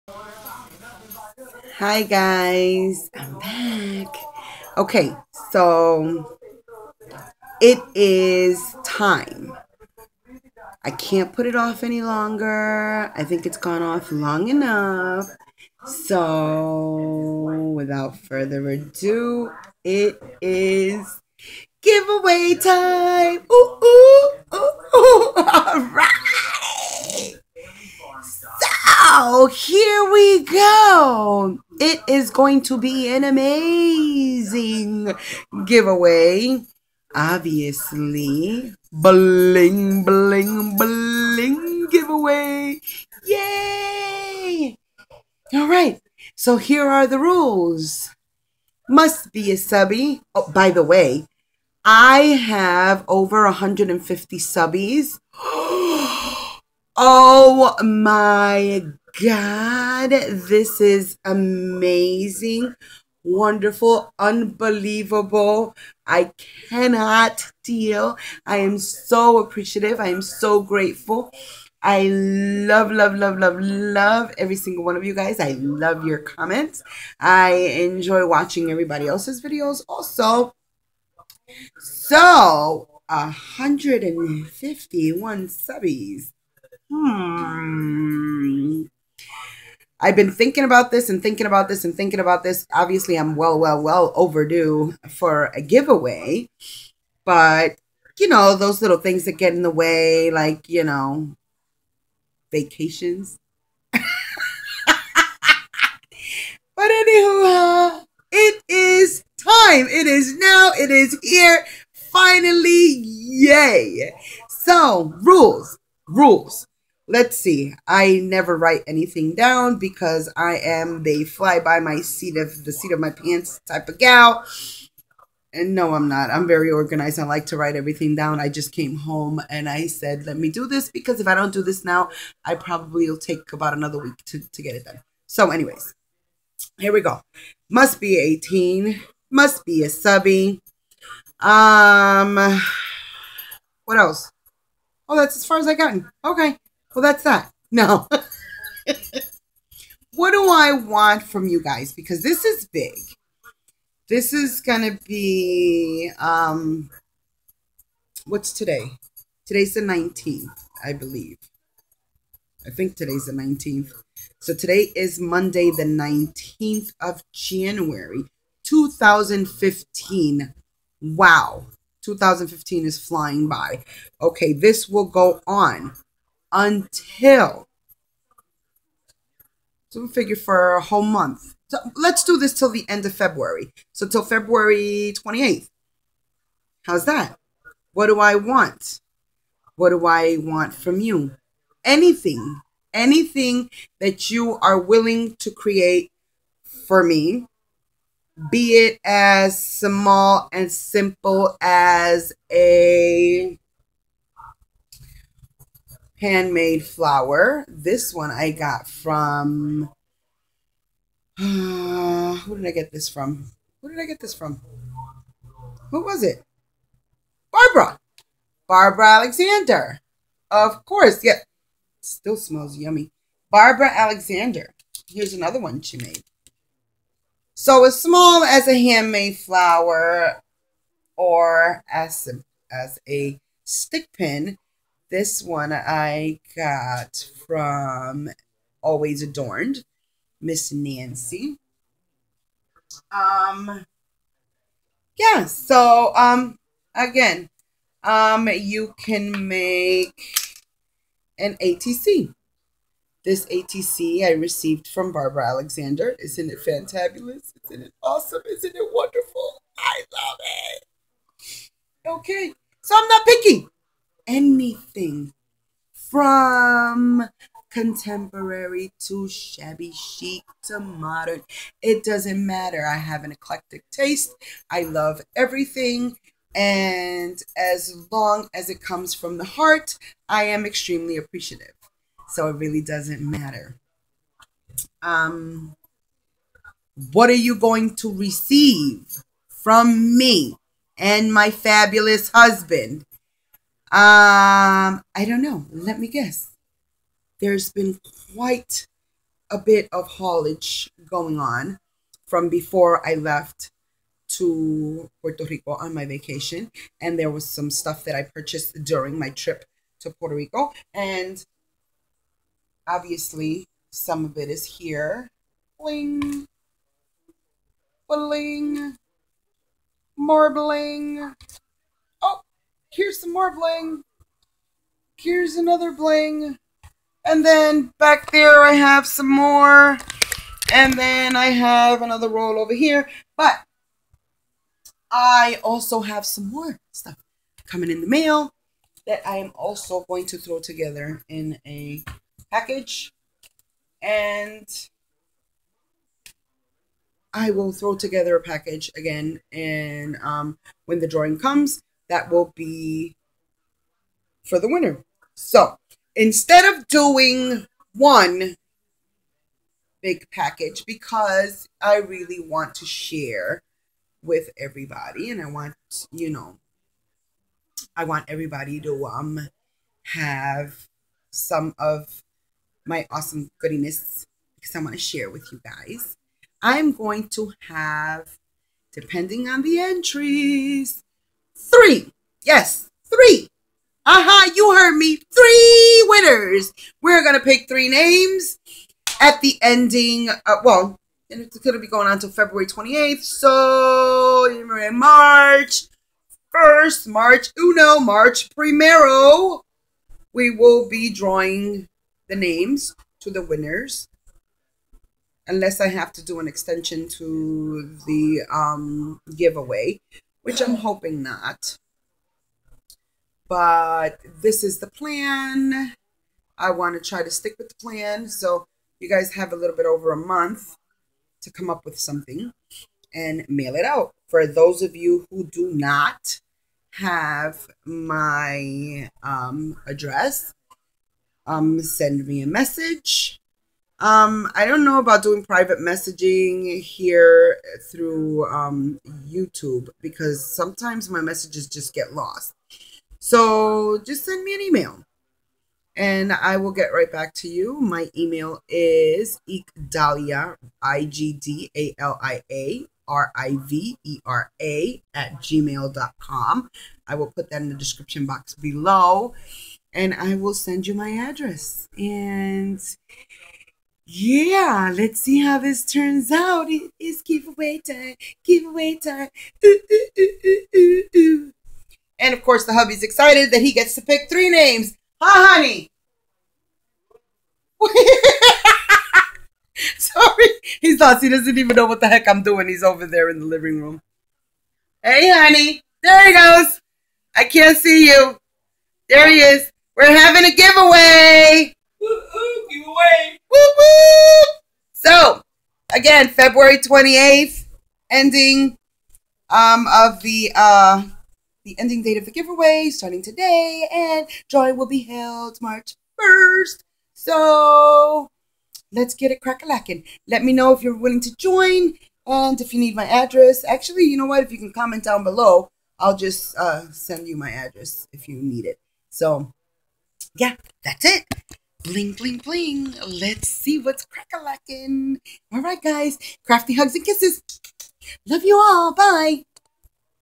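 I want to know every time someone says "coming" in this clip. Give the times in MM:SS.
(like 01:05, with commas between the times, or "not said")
05:37.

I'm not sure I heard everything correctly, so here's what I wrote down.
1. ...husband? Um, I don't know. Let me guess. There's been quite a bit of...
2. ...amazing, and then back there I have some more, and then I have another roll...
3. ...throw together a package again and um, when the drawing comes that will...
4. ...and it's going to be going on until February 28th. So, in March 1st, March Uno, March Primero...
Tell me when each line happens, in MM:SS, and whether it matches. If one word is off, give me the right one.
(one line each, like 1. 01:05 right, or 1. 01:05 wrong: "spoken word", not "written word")
1. 04:52 right
2. 05:25 wrong: "bling", not "amazing"
3. 05:47 right
4. 06:31 right.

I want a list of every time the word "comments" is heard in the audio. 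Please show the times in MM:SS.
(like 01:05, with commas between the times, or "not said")
01:16, 08:34.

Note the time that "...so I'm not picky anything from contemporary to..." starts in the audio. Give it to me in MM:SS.
04:22.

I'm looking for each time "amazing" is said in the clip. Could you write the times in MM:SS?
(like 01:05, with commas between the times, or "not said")
00:33, 01:01.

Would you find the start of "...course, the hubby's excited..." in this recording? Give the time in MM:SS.
07:52.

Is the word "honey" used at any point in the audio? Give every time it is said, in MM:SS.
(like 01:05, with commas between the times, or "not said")
07:55, 08:05.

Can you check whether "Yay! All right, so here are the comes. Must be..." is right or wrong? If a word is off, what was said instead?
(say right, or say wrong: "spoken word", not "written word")
wrong: "rules", not "comes".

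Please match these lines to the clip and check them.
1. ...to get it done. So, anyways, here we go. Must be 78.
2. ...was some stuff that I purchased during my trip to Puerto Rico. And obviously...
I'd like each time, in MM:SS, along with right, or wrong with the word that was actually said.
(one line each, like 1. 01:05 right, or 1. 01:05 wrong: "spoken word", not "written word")
1. 02:14 wrong: "18", not "78"
2. 05:07 right.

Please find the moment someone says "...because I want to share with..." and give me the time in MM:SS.
06:14.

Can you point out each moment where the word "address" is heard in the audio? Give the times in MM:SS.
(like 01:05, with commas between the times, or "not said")
07:09, 07:41, 08:33, 08:37.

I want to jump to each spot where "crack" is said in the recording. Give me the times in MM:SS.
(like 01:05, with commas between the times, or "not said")
08:29, 08:44.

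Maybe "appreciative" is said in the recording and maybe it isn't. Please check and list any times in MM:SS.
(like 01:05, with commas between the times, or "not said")
01:09, 04:41.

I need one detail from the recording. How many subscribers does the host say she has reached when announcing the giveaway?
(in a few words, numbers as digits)
151.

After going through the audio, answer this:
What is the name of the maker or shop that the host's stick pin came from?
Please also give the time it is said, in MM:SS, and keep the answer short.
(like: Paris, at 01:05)
Always Adorned, at 03:58.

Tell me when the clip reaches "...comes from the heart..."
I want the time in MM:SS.
04:38.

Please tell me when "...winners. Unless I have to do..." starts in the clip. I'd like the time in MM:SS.
06:43.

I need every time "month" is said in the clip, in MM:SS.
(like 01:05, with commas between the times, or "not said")
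03:01, 07:00.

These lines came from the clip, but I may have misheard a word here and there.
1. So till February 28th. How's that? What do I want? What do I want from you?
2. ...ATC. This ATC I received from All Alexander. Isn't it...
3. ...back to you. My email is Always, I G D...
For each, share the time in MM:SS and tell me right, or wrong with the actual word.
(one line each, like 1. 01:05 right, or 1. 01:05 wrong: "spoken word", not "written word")
1. 03:03 right
2. 04:11 wrong: "Barbara", not "All"
3. 07:27 wrong: "Igdalia", not "Always".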